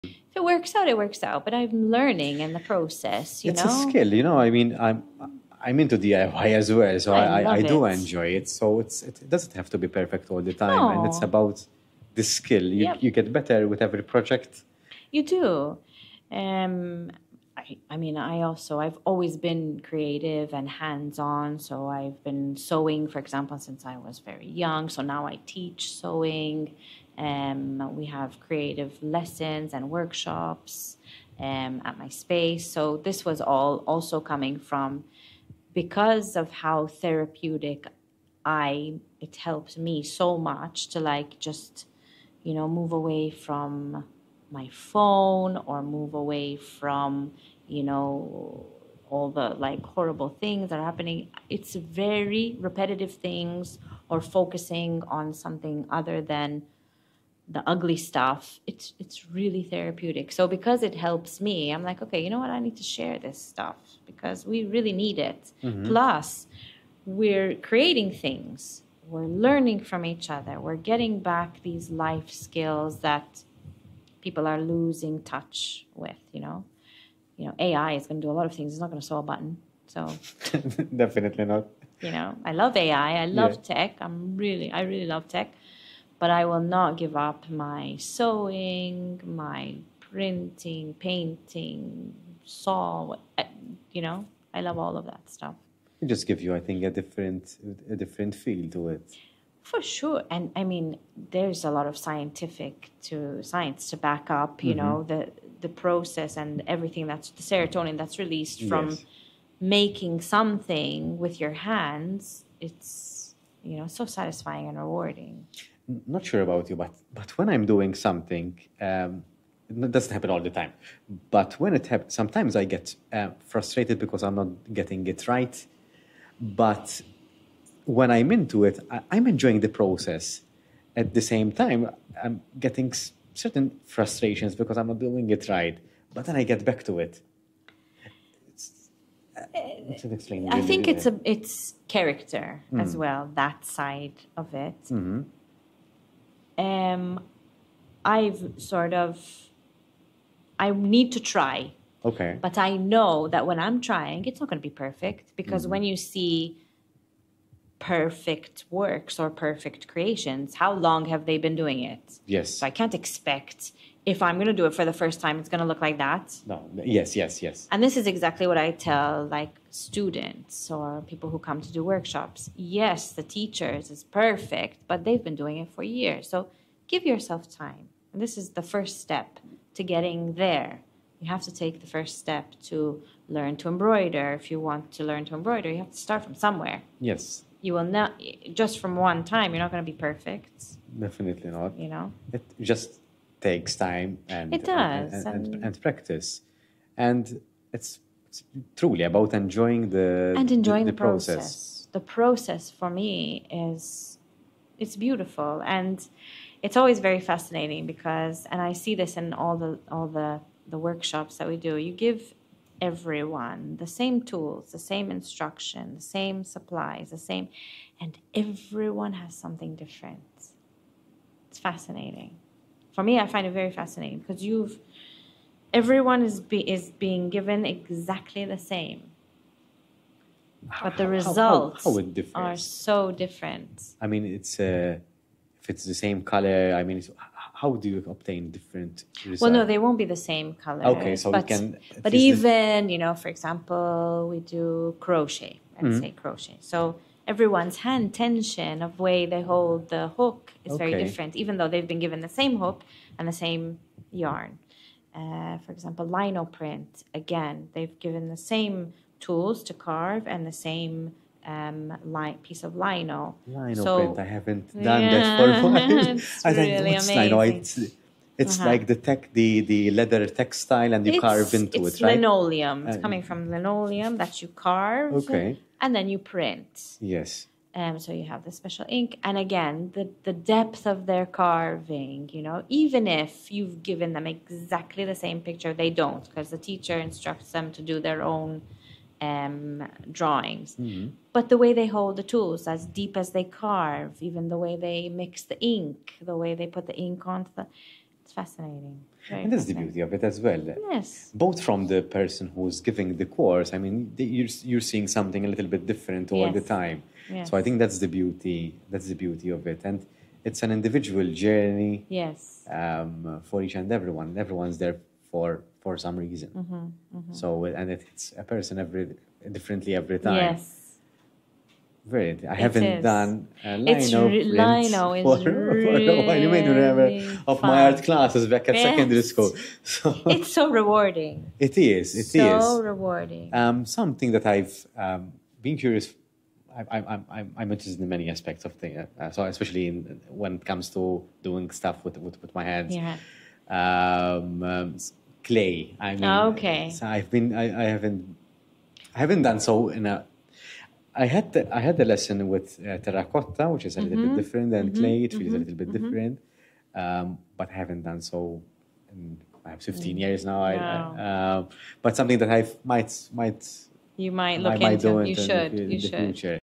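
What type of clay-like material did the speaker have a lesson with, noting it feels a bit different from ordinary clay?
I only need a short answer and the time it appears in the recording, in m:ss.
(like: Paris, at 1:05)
Terracotta, at 5:52.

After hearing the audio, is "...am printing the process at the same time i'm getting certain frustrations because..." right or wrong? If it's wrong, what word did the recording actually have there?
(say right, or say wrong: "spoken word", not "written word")
wrong: "enjoying", not "printing".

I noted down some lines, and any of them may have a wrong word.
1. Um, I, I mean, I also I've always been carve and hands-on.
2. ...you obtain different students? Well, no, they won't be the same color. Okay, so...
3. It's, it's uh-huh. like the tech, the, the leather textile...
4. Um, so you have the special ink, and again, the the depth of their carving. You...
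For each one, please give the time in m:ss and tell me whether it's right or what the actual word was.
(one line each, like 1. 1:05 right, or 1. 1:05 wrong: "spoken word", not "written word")
1. 0:16 wrong: "creative", not "carve"
2. 3:57 wrong: "results", not "students"
3. 4:27 right
4. 4:37 right.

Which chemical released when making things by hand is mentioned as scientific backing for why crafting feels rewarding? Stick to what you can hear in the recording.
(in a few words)
Serotonin.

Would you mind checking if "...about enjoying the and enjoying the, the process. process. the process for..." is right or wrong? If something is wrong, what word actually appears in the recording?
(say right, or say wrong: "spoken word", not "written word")
right.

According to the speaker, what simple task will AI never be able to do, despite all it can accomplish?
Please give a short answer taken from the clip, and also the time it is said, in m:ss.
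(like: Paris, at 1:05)
Sew a button, at 1:19.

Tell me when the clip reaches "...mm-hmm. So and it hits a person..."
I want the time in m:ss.
5:17.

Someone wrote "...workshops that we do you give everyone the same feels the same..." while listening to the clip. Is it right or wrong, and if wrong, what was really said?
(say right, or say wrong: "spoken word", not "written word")
wrong: "tools", not "feels".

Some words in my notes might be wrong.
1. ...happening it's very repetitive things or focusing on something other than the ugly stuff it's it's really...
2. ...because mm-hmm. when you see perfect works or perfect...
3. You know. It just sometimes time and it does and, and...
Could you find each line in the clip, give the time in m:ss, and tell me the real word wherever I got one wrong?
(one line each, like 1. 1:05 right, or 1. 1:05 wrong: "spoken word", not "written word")
1. 0:50 right
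2. 2:35 right
3. 3:11 wrong: "takes", not "sometimes".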